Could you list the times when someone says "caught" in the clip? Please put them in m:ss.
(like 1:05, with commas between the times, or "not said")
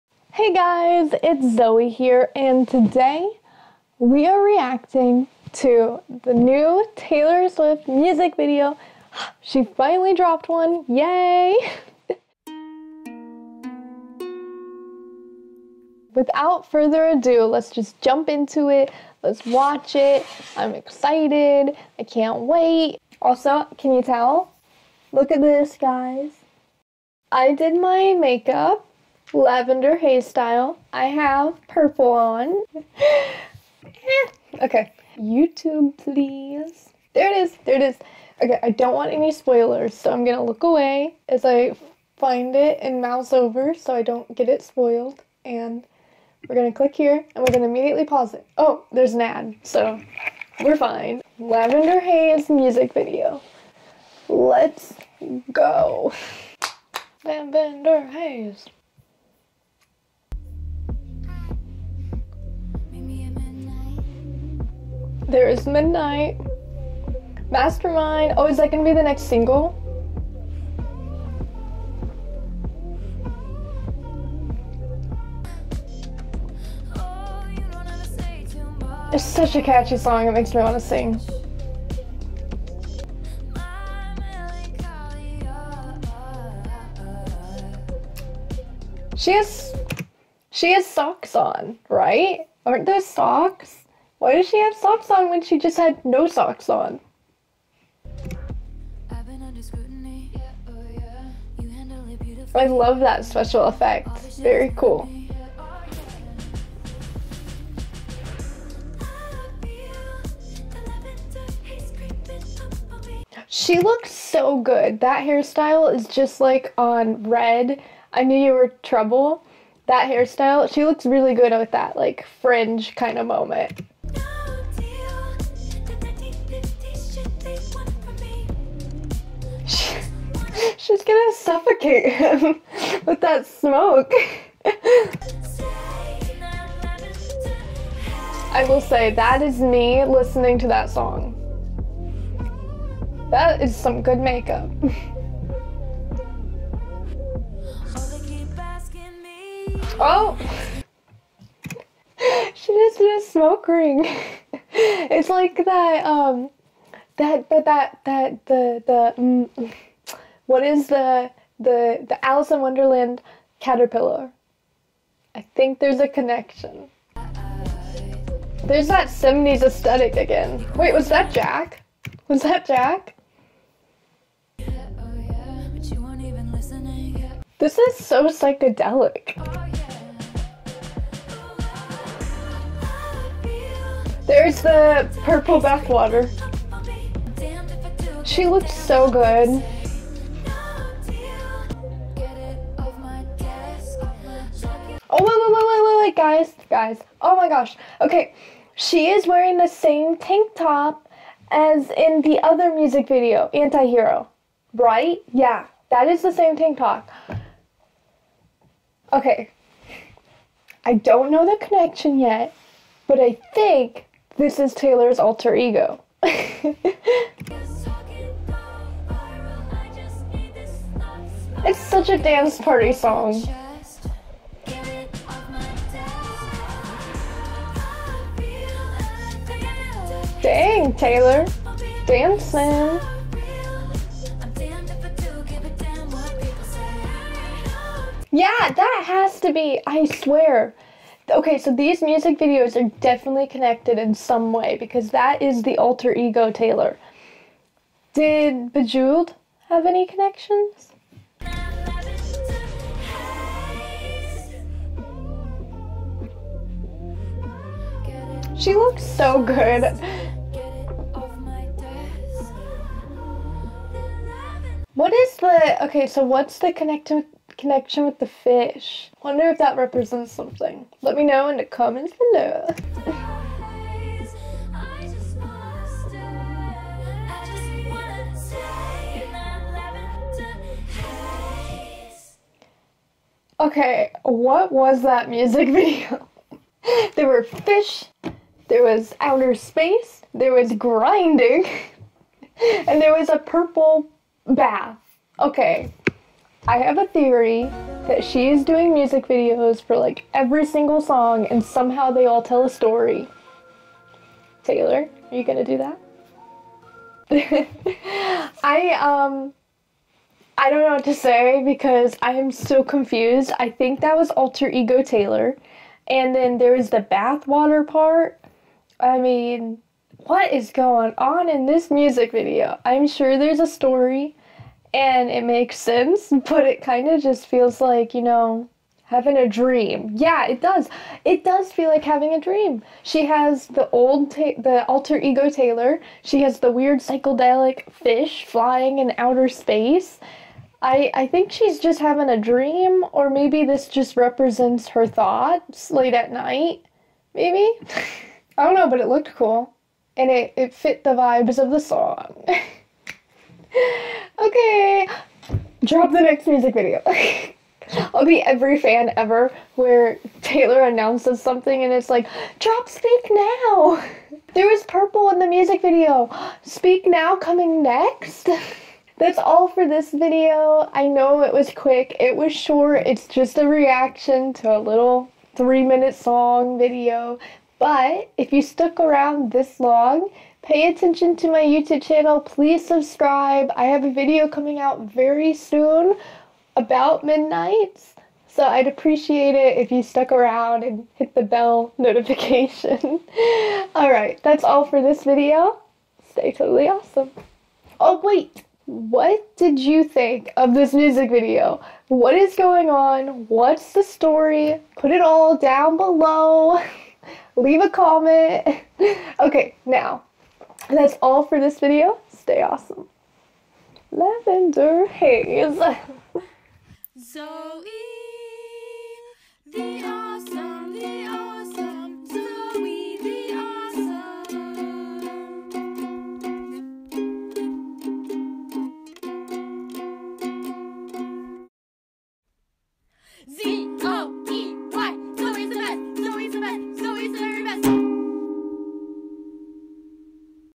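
not said.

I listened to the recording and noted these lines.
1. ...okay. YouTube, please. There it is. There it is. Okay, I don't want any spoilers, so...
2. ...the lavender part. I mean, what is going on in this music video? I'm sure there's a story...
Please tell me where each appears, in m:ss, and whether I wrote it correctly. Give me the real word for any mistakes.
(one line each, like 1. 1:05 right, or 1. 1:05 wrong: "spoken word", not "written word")
1. 0:34 right
2. 5:16 wrong: "bathwater", not "lavender".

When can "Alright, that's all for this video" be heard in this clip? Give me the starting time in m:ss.
6:33.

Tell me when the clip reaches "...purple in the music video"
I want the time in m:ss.
6:04.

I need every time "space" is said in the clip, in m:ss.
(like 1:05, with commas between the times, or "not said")
4:49, 5:39.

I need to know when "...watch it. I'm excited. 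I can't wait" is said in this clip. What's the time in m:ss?
0:19.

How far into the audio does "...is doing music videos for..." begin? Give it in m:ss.
4:58.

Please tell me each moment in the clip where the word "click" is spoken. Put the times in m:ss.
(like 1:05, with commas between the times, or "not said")
0:46.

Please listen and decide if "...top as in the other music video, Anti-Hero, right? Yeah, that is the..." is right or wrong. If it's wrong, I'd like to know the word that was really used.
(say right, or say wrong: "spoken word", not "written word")
right.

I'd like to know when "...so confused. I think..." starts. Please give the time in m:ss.
5:12.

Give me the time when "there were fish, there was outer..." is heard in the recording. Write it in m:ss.
4:47.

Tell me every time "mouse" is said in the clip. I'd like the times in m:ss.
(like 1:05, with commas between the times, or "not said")
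0:43.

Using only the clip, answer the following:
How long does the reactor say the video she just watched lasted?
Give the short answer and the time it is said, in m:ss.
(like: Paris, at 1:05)
3 minutes, at 6:15.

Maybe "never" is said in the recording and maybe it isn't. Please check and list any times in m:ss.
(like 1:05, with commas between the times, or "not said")
not said.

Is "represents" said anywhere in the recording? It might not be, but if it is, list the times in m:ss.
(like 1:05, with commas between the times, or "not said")
4:29, 5:44.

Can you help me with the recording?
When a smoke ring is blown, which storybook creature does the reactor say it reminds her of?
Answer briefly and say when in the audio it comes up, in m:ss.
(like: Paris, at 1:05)
Alice in Wonderland caterpillar, at 2:42.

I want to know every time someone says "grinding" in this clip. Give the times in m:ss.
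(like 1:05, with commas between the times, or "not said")
4:50.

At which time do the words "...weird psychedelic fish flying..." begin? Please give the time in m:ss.
5:36.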